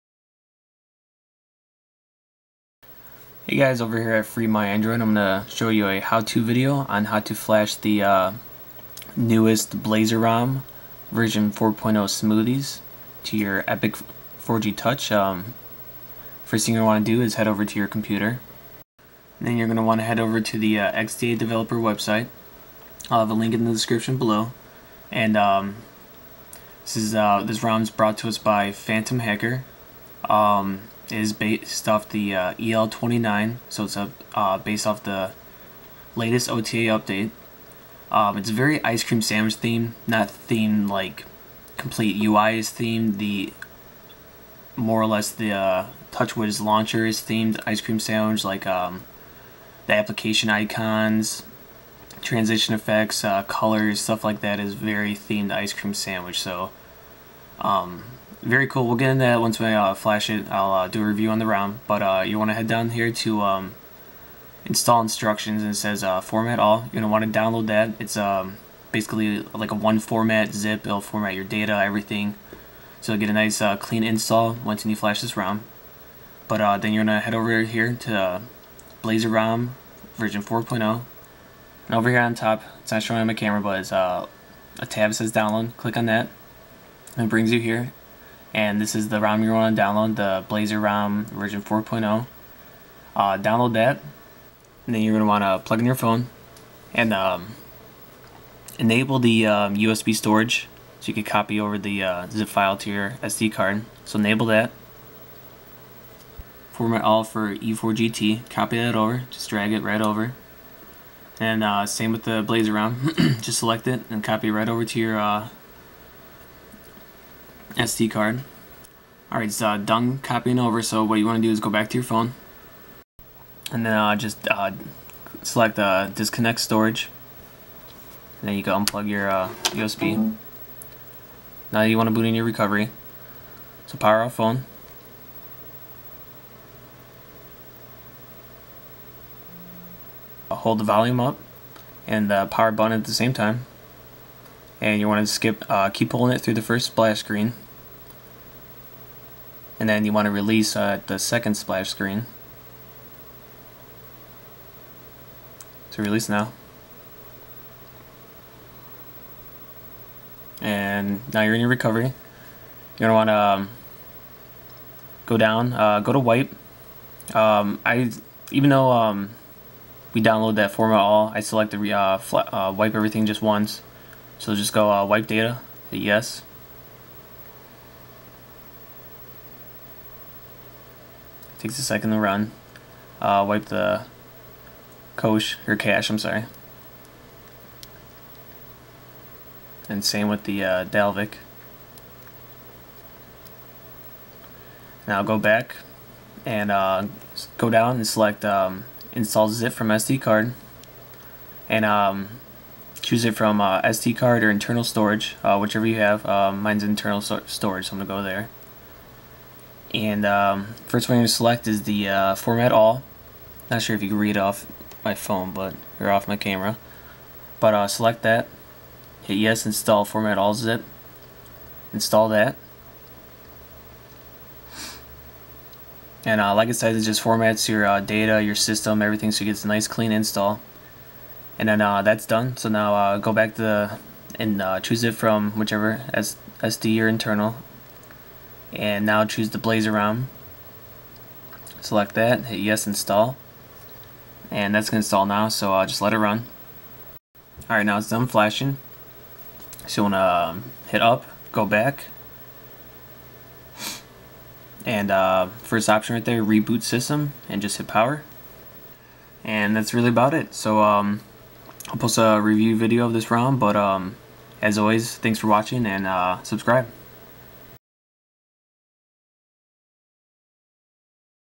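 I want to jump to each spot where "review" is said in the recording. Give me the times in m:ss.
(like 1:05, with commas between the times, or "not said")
1:01, 4:22.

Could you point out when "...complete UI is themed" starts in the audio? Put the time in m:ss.
0:41.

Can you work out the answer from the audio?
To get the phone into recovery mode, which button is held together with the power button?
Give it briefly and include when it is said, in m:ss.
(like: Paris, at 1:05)
volume up, at 2:20.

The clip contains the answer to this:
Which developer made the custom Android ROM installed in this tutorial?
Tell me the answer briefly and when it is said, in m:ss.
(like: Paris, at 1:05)
Phantom Hacker, at 0:28.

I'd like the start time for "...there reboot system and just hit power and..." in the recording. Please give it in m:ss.
4:16.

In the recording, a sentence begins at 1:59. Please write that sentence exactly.
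Alright, it's uh, done copying over, so what you want to do is go back to your phone.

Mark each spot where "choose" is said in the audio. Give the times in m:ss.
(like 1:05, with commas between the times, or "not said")
3:23, 3:54, 3:59.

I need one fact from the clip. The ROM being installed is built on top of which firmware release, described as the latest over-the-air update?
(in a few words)
EL29.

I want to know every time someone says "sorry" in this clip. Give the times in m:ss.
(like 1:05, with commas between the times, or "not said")
3:06.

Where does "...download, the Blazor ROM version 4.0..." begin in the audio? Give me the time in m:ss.
1:29.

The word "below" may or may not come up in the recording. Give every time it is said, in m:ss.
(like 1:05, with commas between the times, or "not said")
0:24.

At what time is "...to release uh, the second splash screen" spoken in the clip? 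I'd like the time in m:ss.
2:30.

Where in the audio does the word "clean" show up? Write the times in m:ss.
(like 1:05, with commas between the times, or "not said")
1:13, 3:49.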